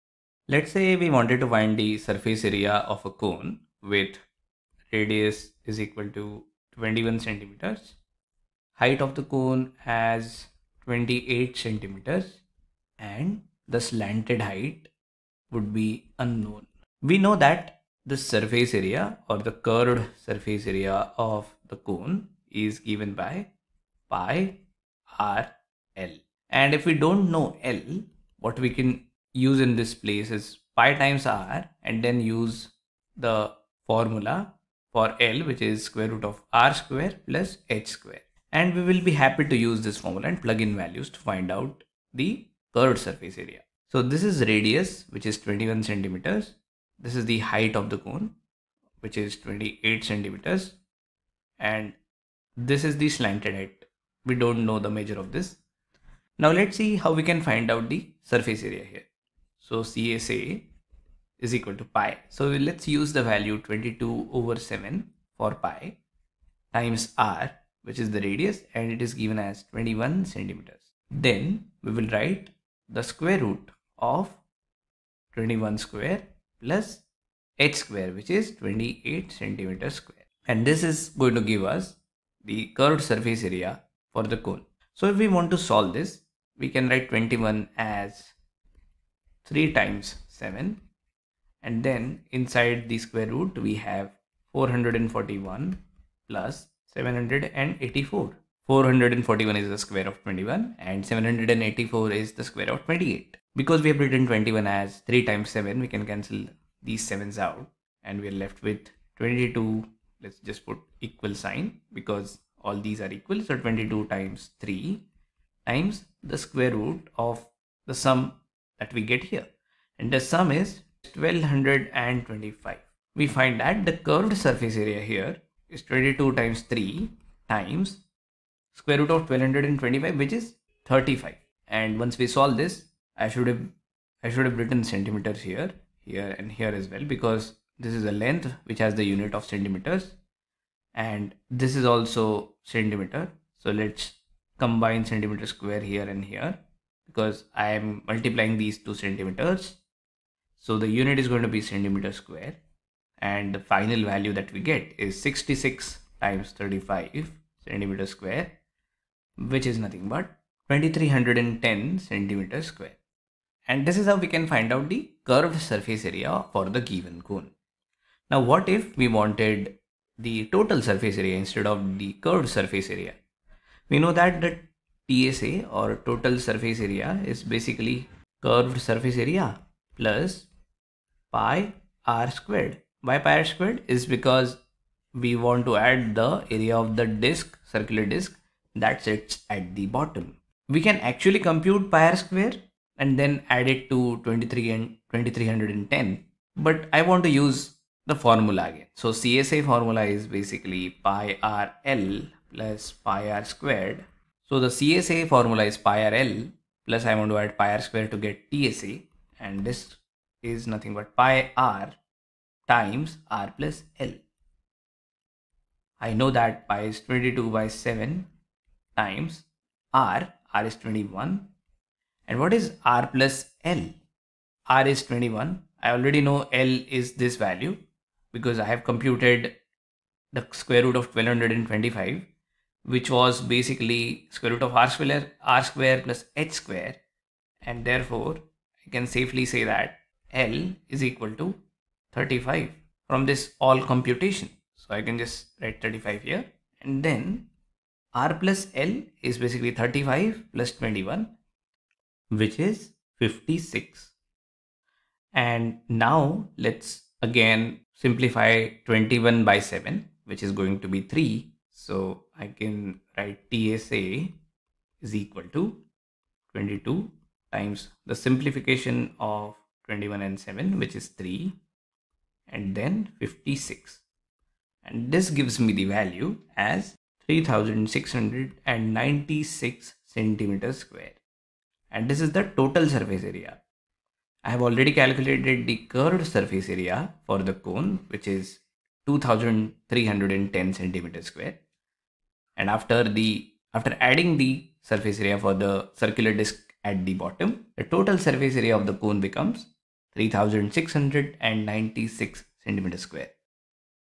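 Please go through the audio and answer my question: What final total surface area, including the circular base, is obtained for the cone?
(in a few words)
3696 square centimeters.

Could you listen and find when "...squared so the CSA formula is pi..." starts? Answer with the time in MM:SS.
03:23.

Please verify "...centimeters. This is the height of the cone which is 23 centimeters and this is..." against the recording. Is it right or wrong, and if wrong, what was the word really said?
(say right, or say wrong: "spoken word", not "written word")
wrong: "28", not "23".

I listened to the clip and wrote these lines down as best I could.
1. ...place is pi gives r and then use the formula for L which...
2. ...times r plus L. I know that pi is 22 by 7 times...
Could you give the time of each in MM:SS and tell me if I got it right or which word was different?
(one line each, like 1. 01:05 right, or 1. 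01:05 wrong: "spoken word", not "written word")
1. 00:29 wrong: "times", not "gives"
2. 03:32 right.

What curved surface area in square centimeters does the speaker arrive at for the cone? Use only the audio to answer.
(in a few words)
2310.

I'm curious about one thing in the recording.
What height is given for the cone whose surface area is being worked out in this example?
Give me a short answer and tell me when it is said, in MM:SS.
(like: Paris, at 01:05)
28 centimeters, at 00:08.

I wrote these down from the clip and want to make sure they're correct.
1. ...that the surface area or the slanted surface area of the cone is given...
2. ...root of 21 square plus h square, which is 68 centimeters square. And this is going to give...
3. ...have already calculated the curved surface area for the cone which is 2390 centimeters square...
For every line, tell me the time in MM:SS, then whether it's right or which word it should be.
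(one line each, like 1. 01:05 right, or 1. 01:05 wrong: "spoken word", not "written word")
1. 00:17 wrong: "curved", not "slanted"
2. 01:13 wrong: "28", not "68"
3. 04:44 wrong: "2310", not "2390".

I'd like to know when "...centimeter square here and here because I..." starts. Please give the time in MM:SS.
02:25.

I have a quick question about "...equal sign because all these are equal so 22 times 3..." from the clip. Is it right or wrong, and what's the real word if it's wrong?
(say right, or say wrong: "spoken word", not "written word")
right.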